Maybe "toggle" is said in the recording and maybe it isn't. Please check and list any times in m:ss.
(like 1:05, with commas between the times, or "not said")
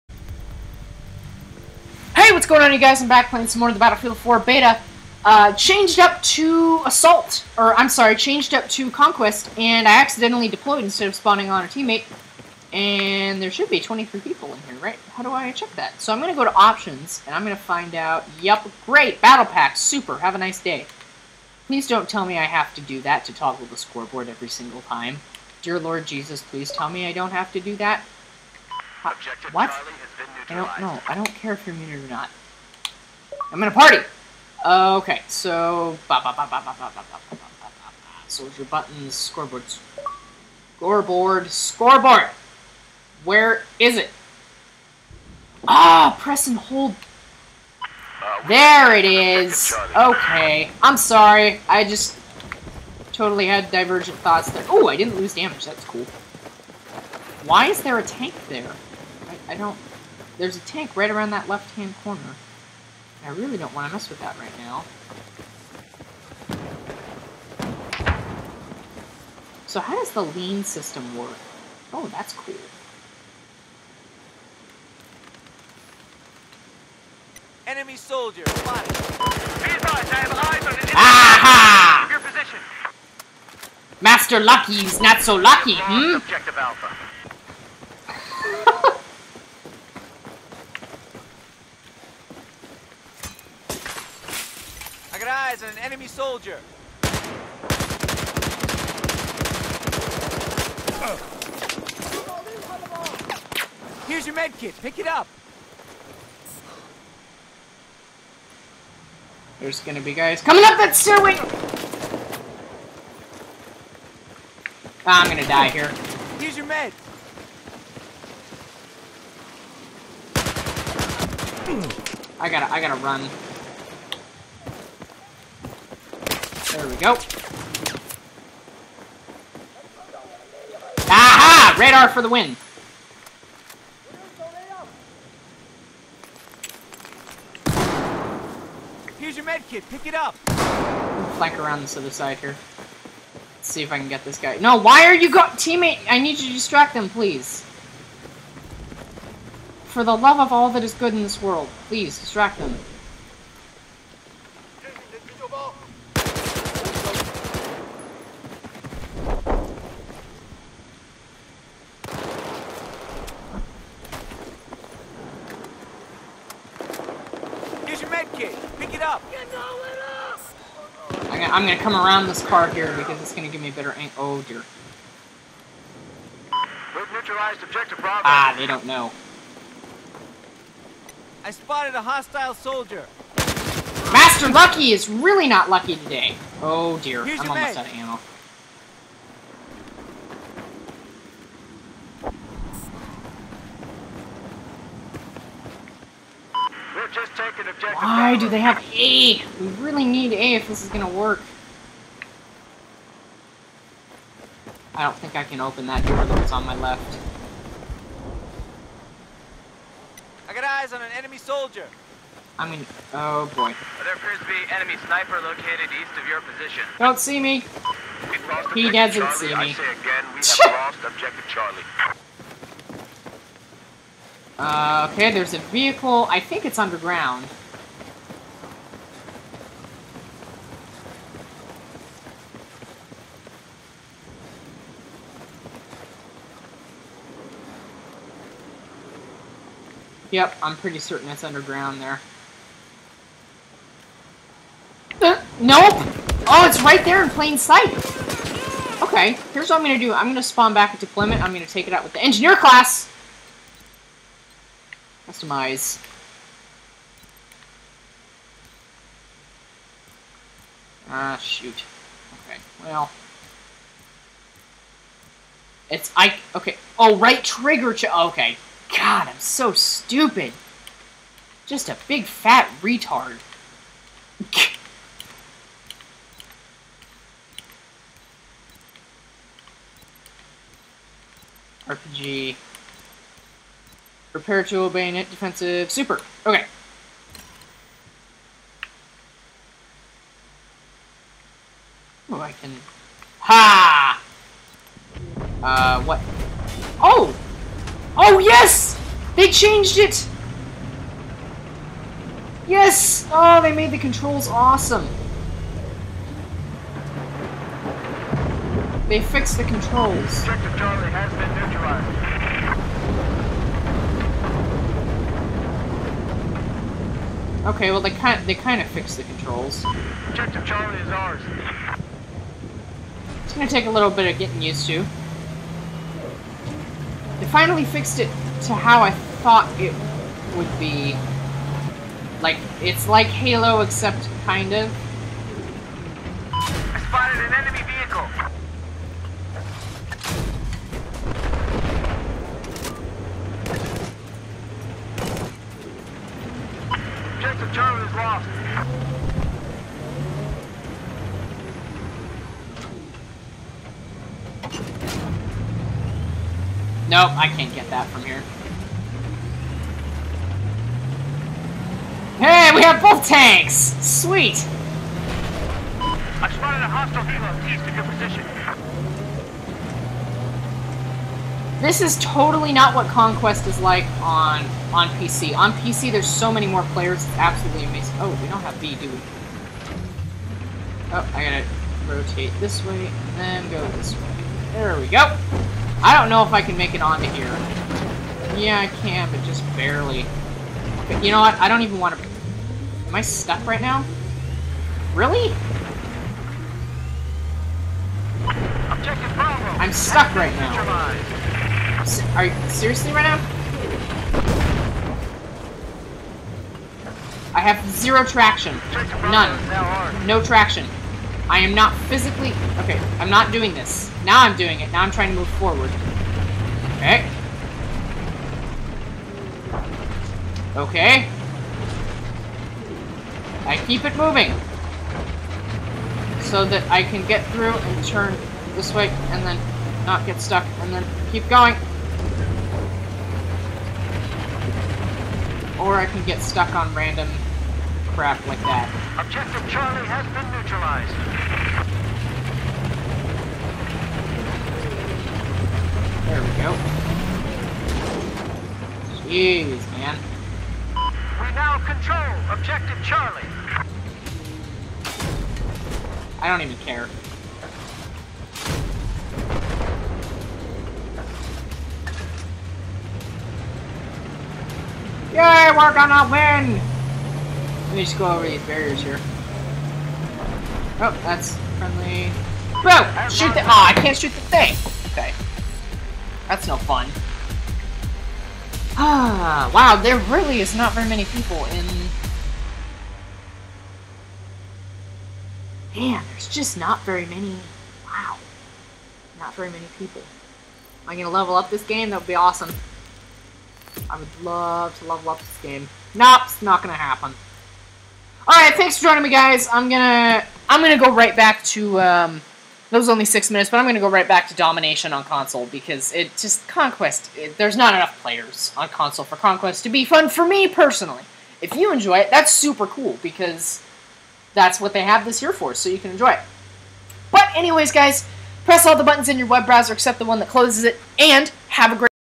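0:23.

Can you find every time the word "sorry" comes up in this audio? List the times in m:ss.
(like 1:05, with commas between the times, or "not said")
0:07, 0:50.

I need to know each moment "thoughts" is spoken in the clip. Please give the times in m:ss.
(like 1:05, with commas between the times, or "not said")
0:54, 5:29.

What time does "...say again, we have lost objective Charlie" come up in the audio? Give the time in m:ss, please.
3:39.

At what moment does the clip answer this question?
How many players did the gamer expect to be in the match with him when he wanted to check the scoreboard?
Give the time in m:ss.
0:13.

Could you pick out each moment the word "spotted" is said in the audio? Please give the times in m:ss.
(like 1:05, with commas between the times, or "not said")
1:18, 3:01, 5:36, 6:06.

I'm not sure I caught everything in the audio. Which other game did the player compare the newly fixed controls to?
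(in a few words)
Halo.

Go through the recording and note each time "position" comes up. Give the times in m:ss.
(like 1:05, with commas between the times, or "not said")
1:22, 3:36, 6:08.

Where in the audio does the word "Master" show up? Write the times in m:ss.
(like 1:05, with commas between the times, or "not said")
1:24, 3:04.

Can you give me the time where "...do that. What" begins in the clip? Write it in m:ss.
0:27.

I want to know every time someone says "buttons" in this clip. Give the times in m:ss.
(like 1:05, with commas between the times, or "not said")
0:38, 8:39.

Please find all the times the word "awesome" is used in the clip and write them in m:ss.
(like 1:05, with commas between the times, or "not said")
5:04, 8:12.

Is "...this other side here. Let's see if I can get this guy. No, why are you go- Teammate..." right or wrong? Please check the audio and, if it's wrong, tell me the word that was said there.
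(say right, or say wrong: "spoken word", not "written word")
right.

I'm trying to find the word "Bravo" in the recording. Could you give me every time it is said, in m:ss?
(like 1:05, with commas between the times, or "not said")
2:57, 6:39.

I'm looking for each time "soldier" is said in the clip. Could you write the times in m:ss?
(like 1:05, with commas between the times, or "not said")
0:38, 1:17, 1:36, 3:02, 3:31.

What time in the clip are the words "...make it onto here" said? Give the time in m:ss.
6:26.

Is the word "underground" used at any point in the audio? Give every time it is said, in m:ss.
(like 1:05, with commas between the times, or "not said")
3:46, 4:01.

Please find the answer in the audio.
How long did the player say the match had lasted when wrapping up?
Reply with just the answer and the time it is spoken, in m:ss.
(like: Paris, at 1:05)
6 minutes, at 8:23.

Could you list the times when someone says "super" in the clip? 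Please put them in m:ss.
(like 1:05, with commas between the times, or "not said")
0:19, 4:45, 8:32.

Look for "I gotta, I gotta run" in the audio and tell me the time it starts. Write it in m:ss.
2:02.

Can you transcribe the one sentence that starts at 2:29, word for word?
For the love of all that is good in this world, please distract them.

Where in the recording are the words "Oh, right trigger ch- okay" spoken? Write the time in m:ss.
4:26.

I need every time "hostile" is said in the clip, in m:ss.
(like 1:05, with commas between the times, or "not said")
3:02, 6:06.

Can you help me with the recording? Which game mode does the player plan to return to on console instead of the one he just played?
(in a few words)
Domination.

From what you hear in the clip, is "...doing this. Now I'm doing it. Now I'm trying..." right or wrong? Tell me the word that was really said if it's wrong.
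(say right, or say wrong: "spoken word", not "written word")
right.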